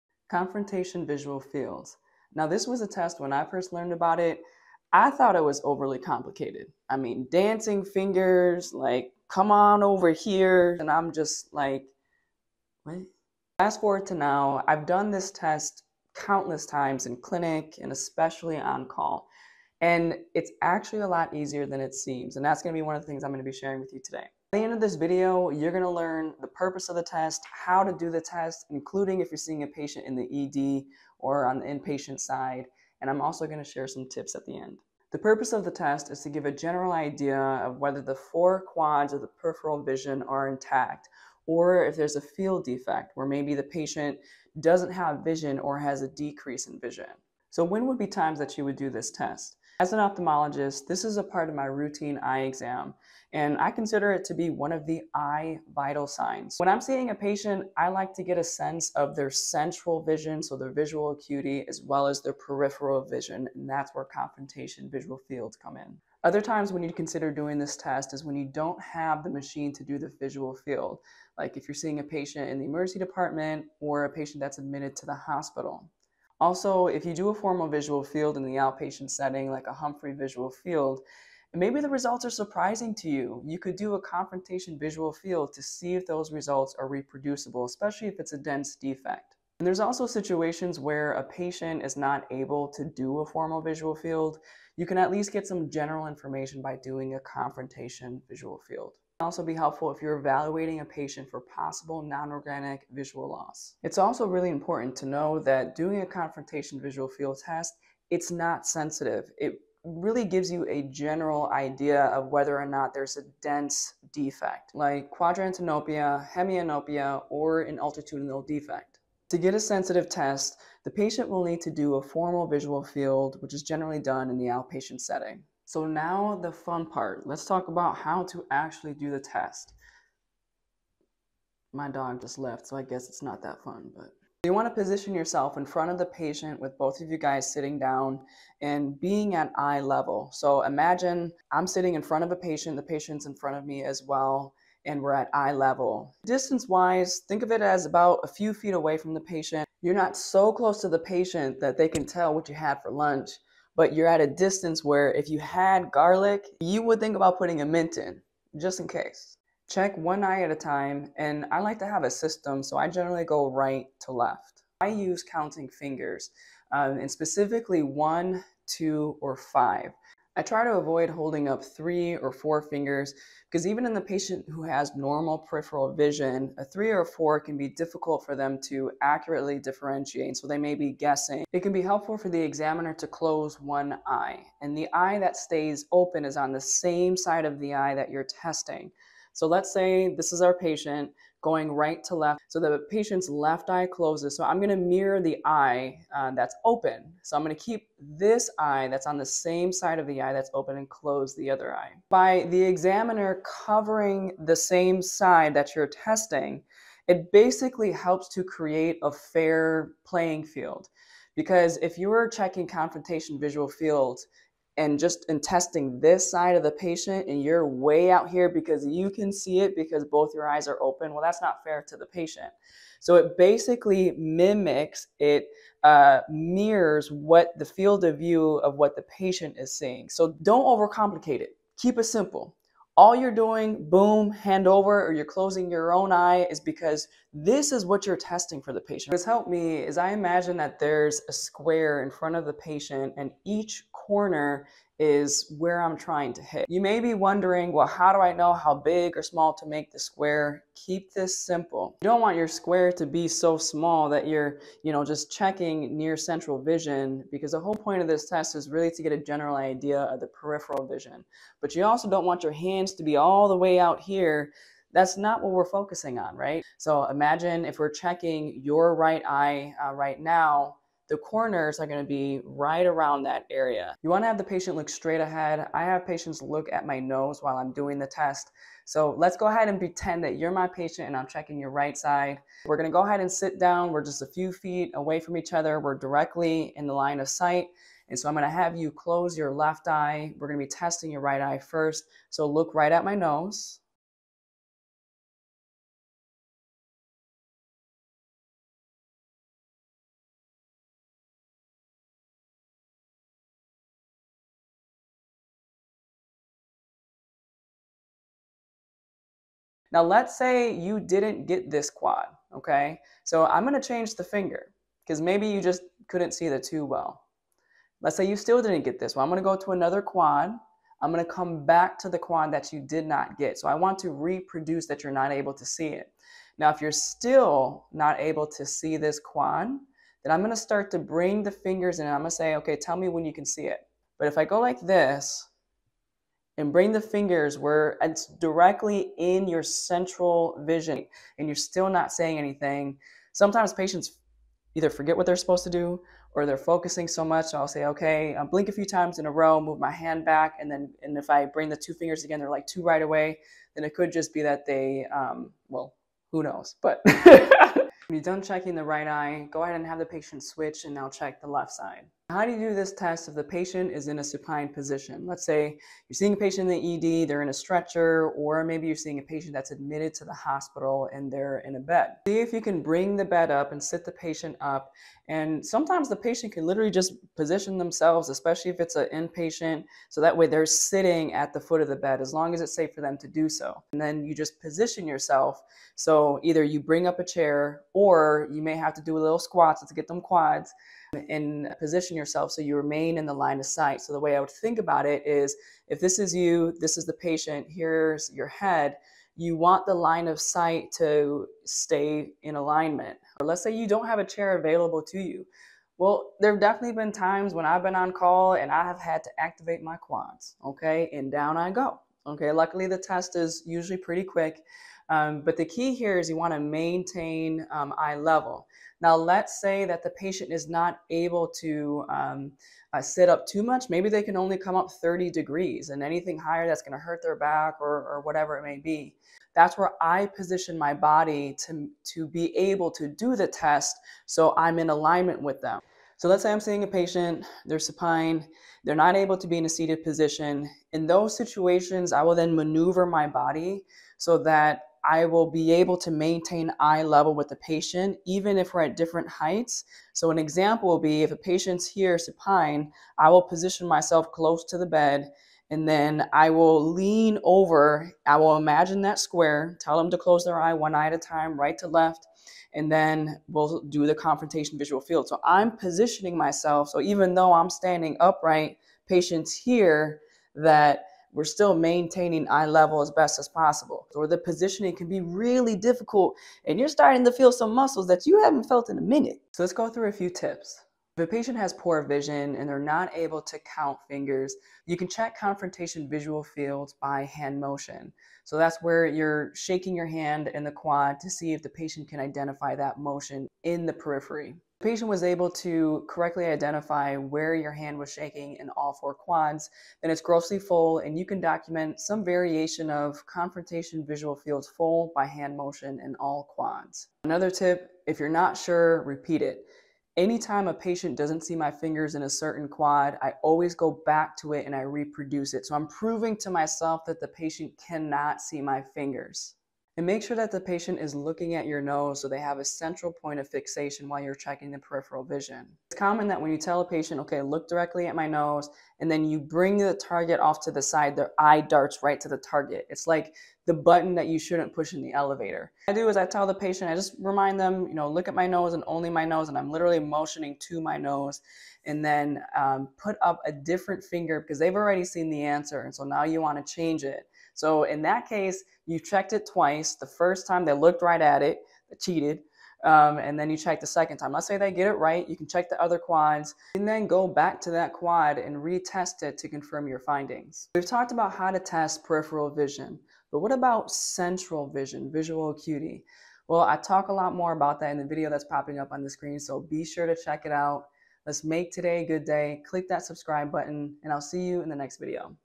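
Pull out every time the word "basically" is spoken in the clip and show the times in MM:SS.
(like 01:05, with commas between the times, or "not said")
03:27, 03:43.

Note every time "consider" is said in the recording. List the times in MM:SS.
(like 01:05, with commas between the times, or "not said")
00:53, 01:06.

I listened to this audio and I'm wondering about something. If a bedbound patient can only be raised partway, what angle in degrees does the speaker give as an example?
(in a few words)
30.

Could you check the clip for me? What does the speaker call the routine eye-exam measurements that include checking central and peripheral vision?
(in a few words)
eye vital signs.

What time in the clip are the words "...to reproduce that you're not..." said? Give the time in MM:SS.
05:23.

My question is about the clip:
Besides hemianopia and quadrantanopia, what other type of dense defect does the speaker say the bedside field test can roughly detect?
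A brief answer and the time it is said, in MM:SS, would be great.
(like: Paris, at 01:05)
altitudinal defect, at 01:57.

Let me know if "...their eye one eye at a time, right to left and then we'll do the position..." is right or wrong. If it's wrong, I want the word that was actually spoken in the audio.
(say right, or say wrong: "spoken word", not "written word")
wrong: "confrontation", not "position".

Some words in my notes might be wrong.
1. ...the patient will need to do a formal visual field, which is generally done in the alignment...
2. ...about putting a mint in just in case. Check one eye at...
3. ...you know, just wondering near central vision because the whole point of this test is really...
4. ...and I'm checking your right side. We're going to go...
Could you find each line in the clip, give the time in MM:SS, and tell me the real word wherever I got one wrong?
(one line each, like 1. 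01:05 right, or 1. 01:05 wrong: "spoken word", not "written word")
1. 02:00 wrong: "outpatient", not "alignment"
2. 02:37 right
3. 04:14 wrong: "checking", not "wondering"
4. 04:41 right.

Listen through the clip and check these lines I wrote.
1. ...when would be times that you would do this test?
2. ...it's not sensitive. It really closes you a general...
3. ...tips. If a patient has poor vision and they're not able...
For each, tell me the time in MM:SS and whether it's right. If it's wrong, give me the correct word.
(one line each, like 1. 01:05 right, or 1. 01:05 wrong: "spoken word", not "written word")
1. 00:47 right
2. 01:48 wrong: "gives", not "closes"
3. 08:00 right.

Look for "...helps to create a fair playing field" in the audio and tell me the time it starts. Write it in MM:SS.
03:27.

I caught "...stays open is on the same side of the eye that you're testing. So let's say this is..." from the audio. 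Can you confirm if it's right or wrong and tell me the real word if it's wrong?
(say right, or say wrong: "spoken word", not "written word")
right.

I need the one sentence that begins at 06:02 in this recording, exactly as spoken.
How do you do this test if the patient is in a supine position?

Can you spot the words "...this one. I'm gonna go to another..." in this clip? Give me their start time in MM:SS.
05:18.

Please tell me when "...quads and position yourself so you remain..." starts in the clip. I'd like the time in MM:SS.
06:30.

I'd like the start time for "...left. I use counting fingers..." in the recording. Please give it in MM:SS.
02:44.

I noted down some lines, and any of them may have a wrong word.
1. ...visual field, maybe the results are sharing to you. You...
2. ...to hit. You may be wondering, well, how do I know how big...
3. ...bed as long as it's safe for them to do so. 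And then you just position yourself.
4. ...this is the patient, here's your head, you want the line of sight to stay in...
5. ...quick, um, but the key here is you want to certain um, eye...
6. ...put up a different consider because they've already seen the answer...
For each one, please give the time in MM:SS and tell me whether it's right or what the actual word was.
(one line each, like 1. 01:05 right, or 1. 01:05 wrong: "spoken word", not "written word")
1. 01:20 wrong: "surprising", not "sharing"
2. 04:06 right
3. 06:21 right
4. 06:36 right
5. 06:54 wrong: "maintain", not "certain"
6. 09:02 wrong: "finger", not "consider".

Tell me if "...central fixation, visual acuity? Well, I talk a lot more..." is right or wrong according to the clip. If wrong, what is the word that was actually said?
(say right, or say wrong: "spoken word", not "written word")
wrong: "vision", not "fixation".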